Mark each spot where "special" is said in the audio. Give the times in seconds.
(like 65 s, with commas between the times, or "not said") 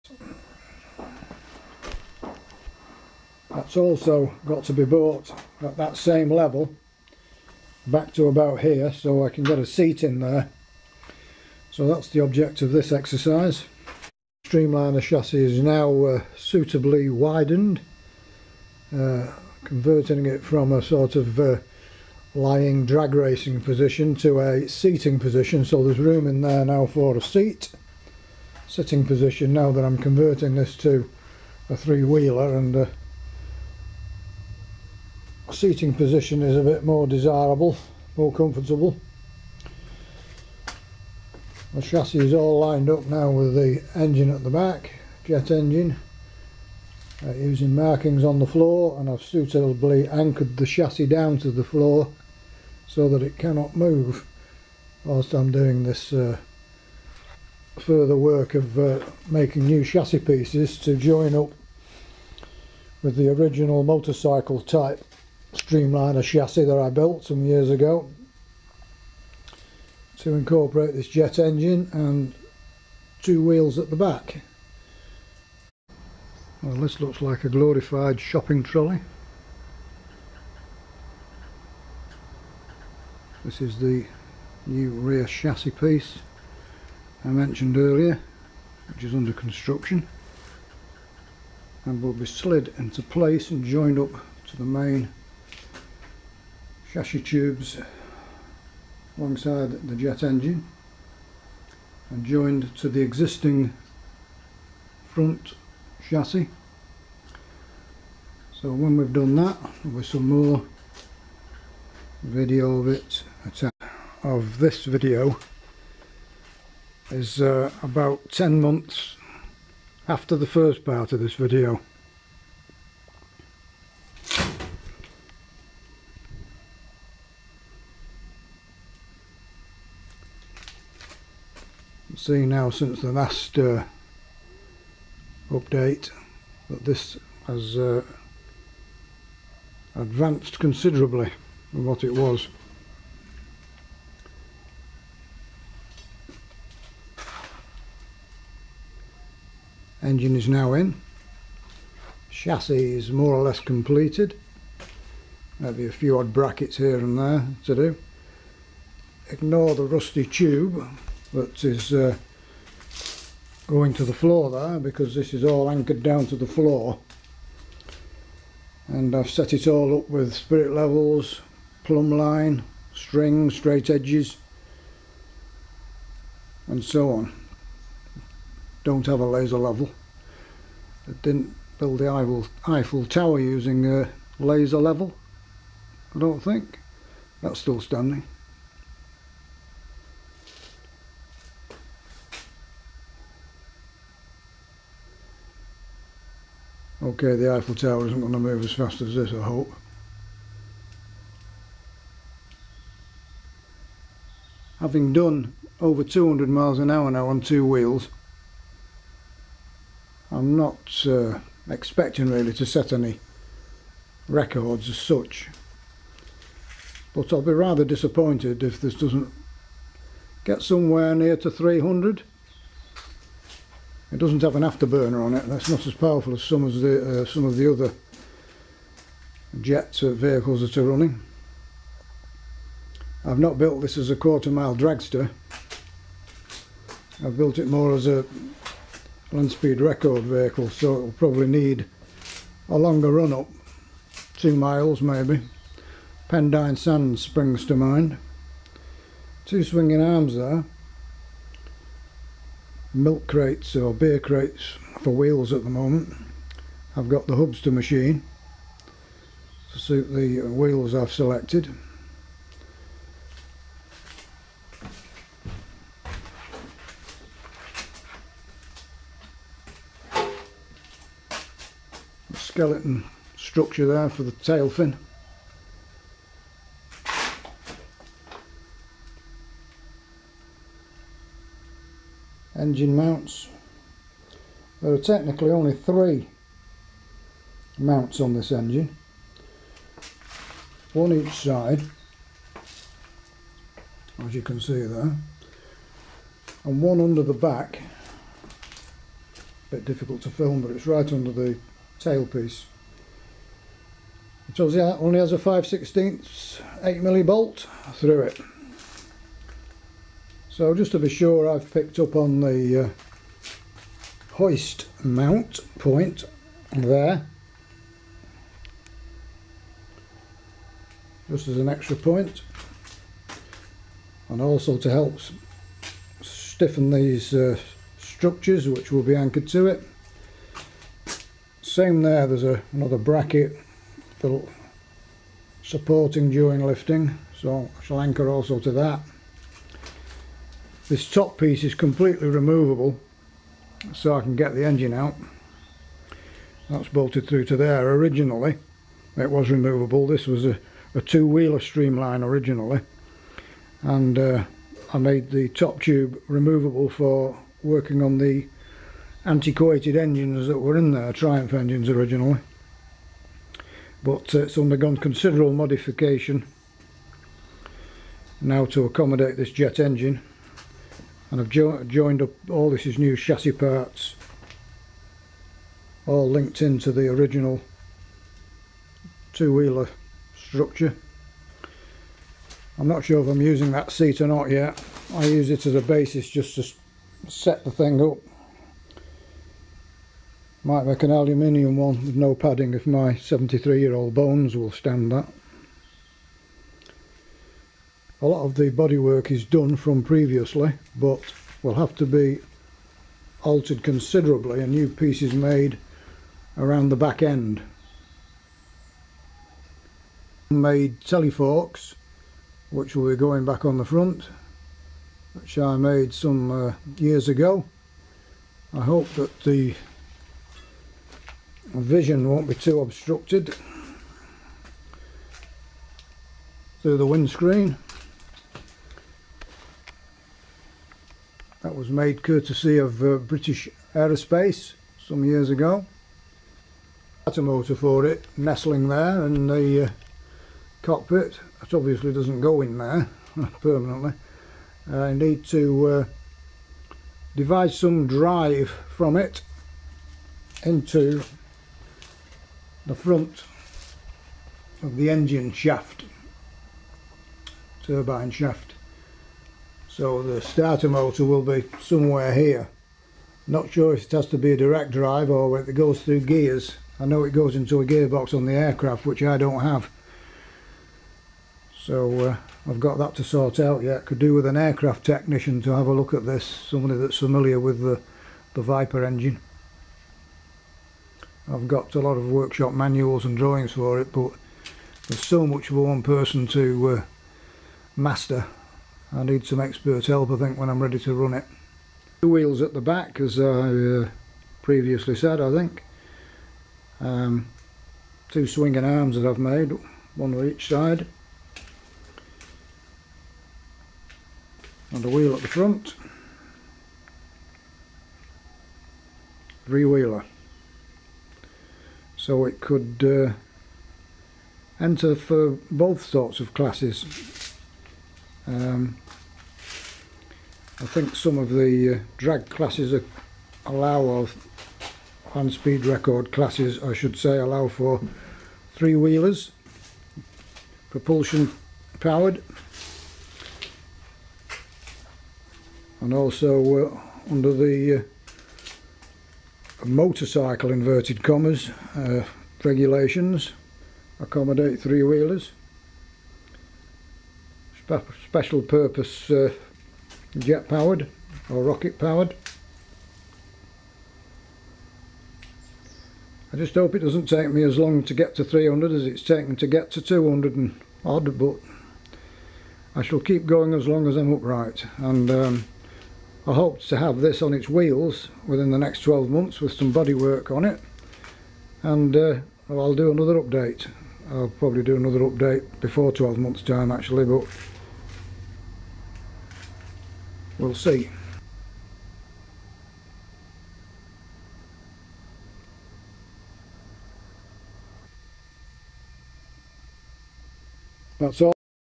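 548 s.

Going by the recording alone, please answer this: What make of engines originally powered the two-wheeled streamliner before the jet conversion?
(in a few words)
Triumph.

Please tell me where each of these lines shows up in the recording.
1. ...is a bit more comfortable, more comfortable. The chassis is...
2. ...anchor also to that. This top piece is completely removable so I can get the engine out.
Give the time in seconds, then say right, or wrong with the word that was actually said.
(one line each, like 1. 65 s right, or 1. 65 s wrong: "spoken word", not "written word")
1. 36 s wrong: "desirable", not "comfortable"
2. 338 s right.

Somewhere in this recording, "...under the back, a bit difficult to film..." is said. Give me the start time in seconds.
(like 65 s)
297 s.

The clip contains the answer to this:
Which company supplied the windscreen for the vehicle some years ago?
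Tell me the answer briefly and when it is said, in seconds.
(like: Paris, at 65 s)
British Aerospace, at 433 s.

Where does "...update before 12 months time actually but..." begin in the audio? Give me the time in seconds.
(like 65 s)
575 s.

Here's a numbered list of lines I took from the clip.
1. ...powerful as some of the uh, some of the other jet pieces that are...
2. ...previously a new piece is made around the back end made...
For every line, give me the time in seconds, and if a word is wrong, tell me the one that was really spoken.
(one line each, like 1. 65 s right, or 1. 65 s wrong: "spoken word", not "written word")
1. 225 s wrong: "vehicles", not "pieces"
2. 403 s wrong: "considerably", not "previously".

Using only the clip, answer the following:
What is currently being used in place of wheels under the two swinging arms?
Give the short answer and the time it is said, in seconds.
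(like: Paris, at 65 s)
Milk crates, at 252 s.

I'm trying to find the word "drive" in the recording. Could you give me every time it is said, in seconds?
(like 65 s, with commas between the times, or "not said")
448 s, 464 s.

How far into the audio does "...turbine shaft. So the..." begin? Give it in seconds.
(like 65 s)
457 s.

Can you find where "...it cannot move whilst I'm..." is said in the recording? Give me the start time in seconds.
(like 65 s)
53 s.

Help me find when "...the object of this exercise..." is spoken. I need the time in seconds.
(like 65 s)
12 s.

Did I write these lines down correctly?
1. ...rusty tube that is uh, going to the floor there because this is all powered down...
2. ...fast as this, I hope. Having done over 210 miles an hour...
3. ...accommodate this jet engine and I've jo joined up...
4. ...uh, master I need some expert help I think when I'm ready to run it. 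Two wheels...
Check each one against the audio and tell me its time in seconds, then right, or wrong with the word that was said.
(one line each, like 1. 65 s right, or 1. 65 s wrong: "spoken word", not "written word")
1. 159 s wrong: "anchored", not "powered"
2. 198 s wrong: "200", not "210"
3. 368 s right
4. 486 s right.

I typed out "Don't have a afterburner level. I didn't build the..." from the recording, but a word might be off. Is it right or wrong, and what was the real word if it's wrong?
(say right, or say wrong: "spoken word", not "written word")
wrong: "laser", not "afterburner".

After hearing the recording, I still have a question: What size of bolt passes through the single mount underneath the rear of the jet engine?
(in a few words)
8mm.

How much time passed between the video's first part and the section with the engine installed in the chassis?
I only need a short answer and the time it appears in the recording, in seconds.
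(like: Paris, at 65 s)
10 months, at 118 s.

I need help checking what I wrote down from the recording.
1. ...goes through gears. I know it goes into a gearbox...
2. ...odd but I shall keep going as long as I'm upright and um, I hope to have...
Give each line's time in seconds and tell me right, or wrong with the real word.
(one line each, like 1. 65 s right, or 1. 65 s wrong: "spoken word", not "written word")
1. 465 s right
2. 561 s right.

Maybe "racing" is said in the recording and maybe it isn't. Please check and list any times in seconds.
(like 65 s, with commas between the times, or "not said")
23 s.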